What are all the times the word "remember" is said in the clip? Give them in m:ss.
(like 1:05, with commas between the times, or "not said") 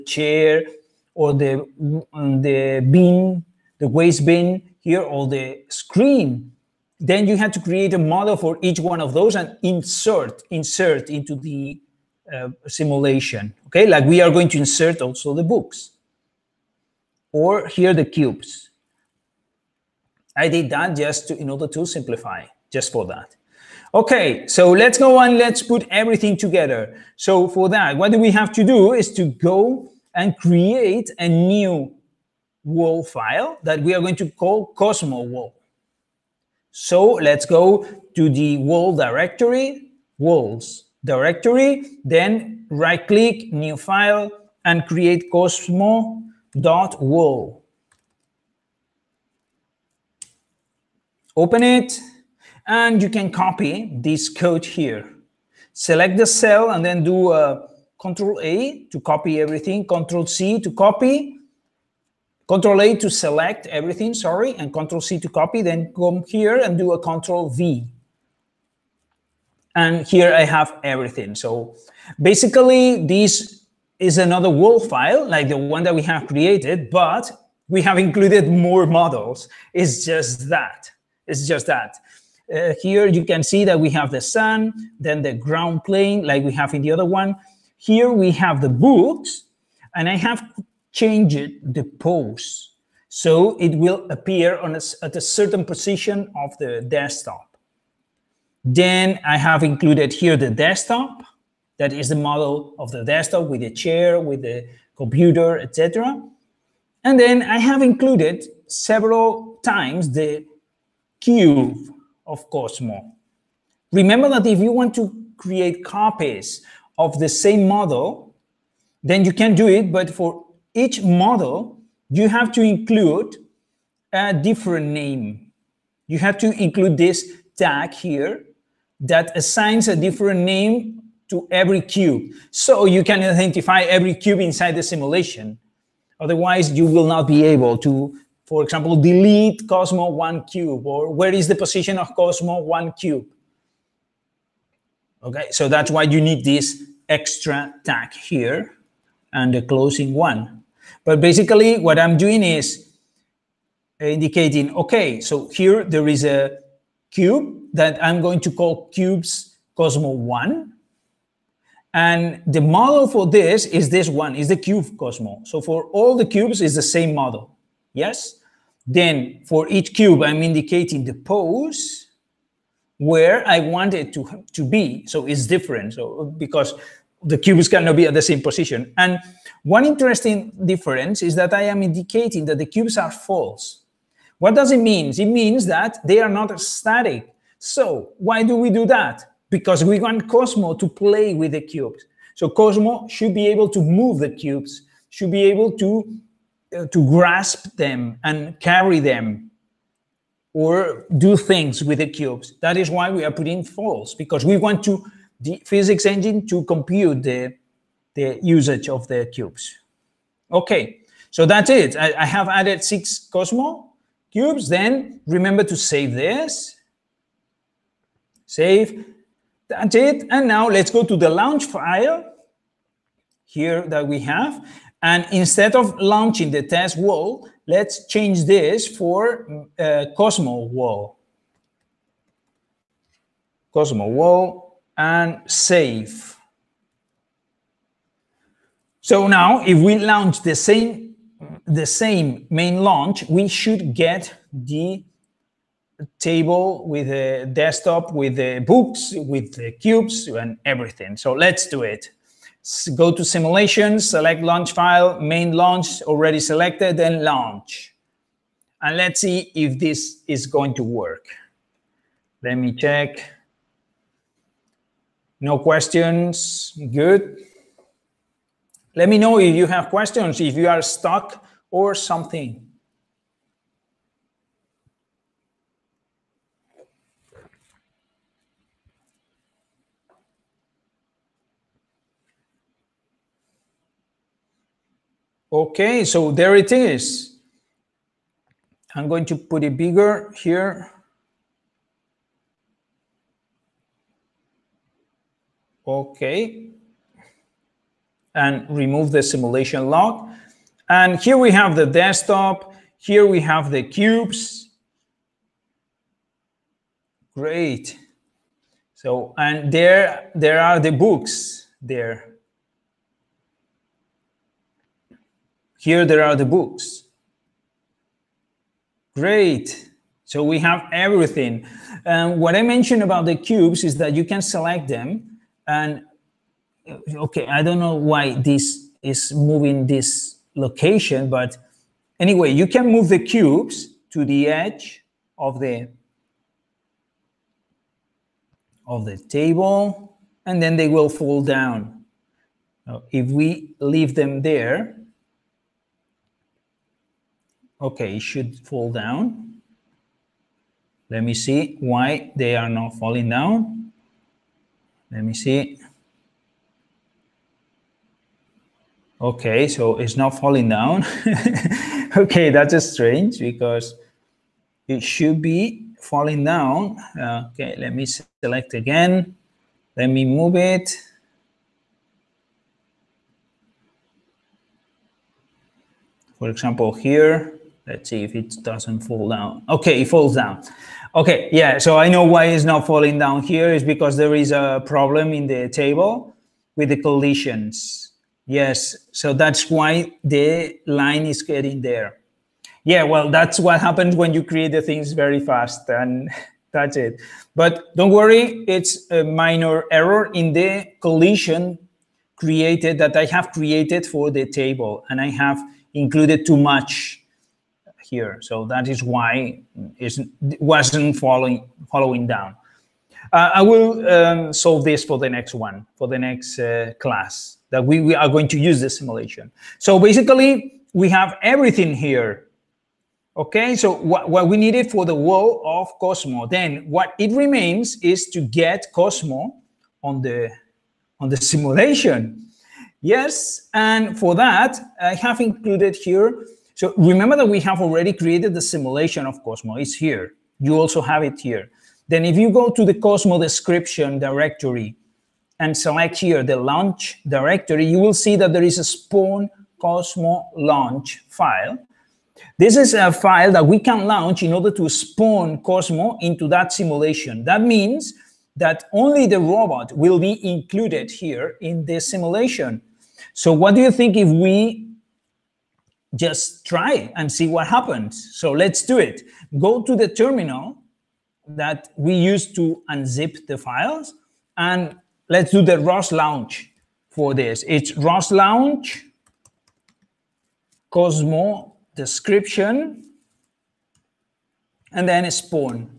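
1:53, 3:35, 7:16.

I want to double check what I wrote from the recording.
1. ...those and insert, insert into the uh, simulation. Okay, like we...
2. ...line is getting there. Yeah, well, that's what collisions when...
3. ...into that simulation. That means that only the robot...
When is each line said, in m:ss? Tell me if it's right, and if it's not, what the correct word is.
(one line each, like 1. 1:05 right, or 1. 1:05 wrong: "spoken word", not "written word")
1. 0:09 right
2. 6:30 wrong: "happens", not "collisions"
3. 7:36 right.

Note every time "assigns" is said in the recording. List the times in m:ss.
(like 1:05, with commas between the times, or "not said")
2:09.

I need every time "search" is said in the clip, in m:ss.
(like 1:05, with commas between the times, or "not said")
not said.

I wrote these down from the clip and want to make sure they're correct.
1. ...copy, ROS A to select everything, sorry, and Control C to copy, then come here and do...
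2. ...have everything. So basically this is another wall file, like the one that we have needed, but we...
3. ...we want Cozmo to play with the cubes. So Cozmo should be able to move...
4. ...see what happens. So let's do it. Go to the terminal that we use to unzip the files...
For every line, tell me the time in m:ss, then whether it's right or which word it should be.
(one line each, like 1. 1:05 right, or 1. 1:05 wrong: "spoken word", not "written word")
1. 1:00 wrong: "Control", not "ROS"
2. 1:10 wrong: "created", not "needed"
3. 3:09 right
4. 7:47 right.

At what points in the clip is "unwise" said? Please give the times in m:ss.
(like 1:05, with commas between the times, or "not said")
not said.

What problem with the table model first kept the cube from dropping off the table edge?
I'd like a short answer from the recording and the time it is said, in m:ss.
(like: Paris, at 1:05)
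collisions, at 6:26.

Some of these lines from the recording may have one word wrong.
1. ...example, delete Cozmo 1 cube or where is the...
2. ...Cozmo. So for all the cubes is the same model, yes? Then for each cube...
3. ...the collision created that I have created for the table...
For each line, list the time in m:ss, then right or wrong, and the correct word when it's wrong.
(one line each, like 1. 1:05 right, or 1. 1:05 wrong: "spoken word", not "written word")
1. 2:18 right
2. 2:44 right
3. 6:40 right.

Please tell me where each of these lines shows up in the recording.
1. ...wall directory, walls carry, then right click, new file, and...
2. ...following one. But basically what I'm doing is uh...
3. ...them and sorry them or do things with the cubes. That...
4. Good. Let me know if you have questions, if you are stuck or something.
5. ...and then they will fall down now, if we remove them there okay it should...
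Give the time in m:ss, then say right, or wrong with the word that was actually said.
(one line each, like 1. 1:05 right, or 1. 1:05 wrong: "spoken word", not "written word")
1. 0:38 wrong: "directory", not "carry"
2. 2:29 wrong: "closing", not "following"
3. 3:17 wrong: "carry", not "sorry"
4. 4:26 right
5. 5:40 wrong: "leave", not "remove".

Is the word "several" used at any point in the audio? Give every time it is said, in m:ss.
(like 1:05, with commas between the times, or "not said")
1:48.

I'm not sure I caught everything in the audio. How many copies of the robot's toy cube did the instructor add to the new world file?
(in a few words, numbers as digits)
6.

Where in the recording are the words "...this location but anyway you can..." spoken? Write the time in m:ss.
5:29.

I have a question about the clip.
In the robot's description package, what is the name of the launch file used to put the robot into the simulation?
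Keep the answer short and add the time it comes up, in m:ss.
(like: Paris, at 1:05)
spawn Cozmo launch, at 7:28.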